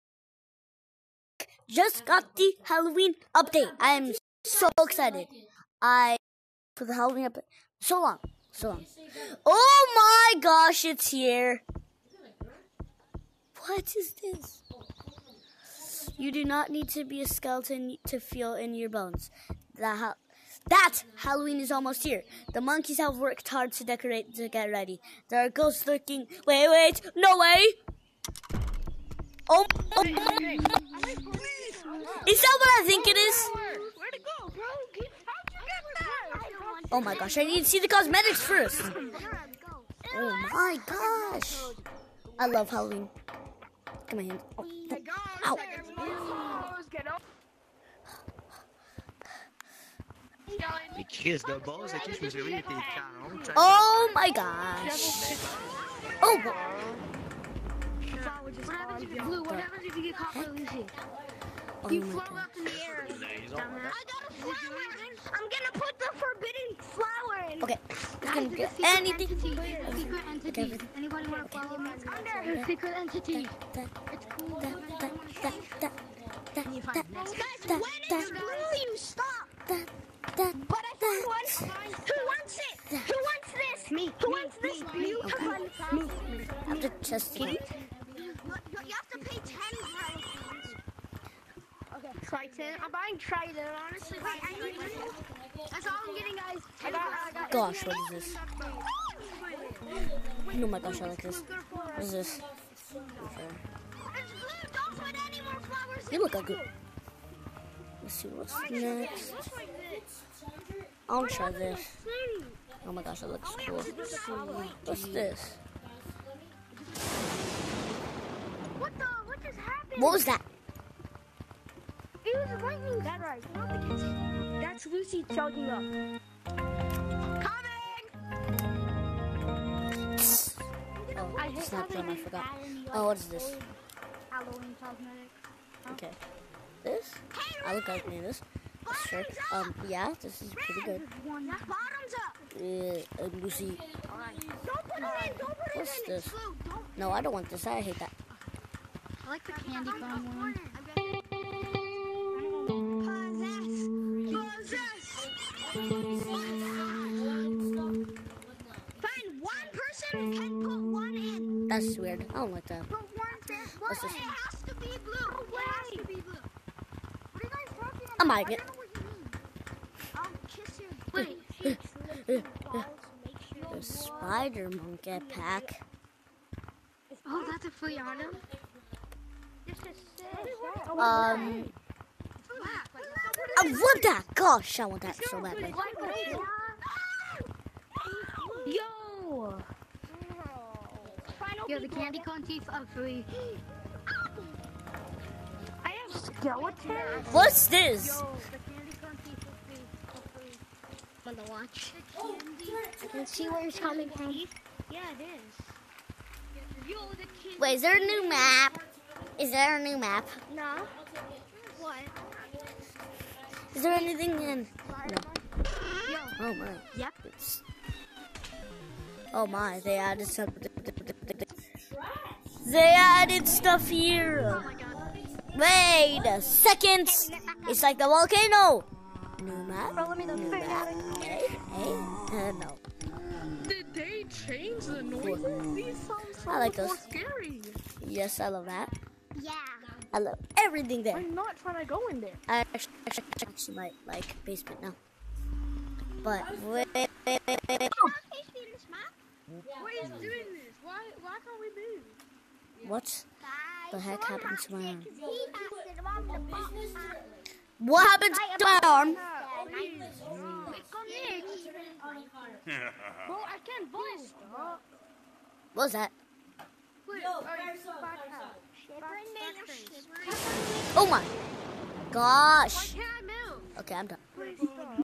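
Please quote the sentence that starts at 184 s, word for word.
Gosh, I want that so badly.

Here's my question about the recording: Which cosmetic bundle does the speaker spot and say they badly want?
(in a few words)
spider monkey pack.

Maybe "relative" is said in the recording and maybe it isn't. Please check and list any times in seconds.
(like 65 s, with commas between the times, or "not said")
not said.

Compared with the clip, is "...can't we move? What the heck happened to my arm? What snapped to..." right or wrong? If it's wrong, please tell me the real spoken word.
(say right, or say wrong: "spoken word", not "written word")
wrong: "happened", not "snapped".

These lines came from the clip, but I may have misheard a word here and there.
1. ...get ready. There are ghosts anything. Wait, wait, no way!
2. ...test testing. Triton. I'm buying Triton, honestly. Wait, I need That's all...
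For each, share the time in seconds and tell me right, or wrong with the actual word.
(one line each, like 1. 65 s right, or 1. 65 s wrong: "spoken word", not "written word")
1. 24 s wrong: "lurking", not "anything"
2. 86 s right.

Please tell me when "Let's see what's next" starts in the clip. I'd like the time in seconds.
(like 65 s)
108 s.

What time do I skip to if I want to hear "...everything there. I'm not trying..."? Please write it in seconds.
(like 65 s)
240 s.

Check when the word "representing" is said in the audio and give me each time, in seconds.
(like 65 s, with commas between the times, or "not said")
not said.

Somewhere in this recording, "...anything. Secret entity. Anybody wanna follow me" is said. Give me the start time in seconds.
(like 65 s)
68 s.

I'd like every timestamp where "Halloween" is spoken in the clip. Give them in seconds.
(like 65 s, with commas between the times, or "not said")
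2 s, 6 s, 21 s, 42 s, 134 s.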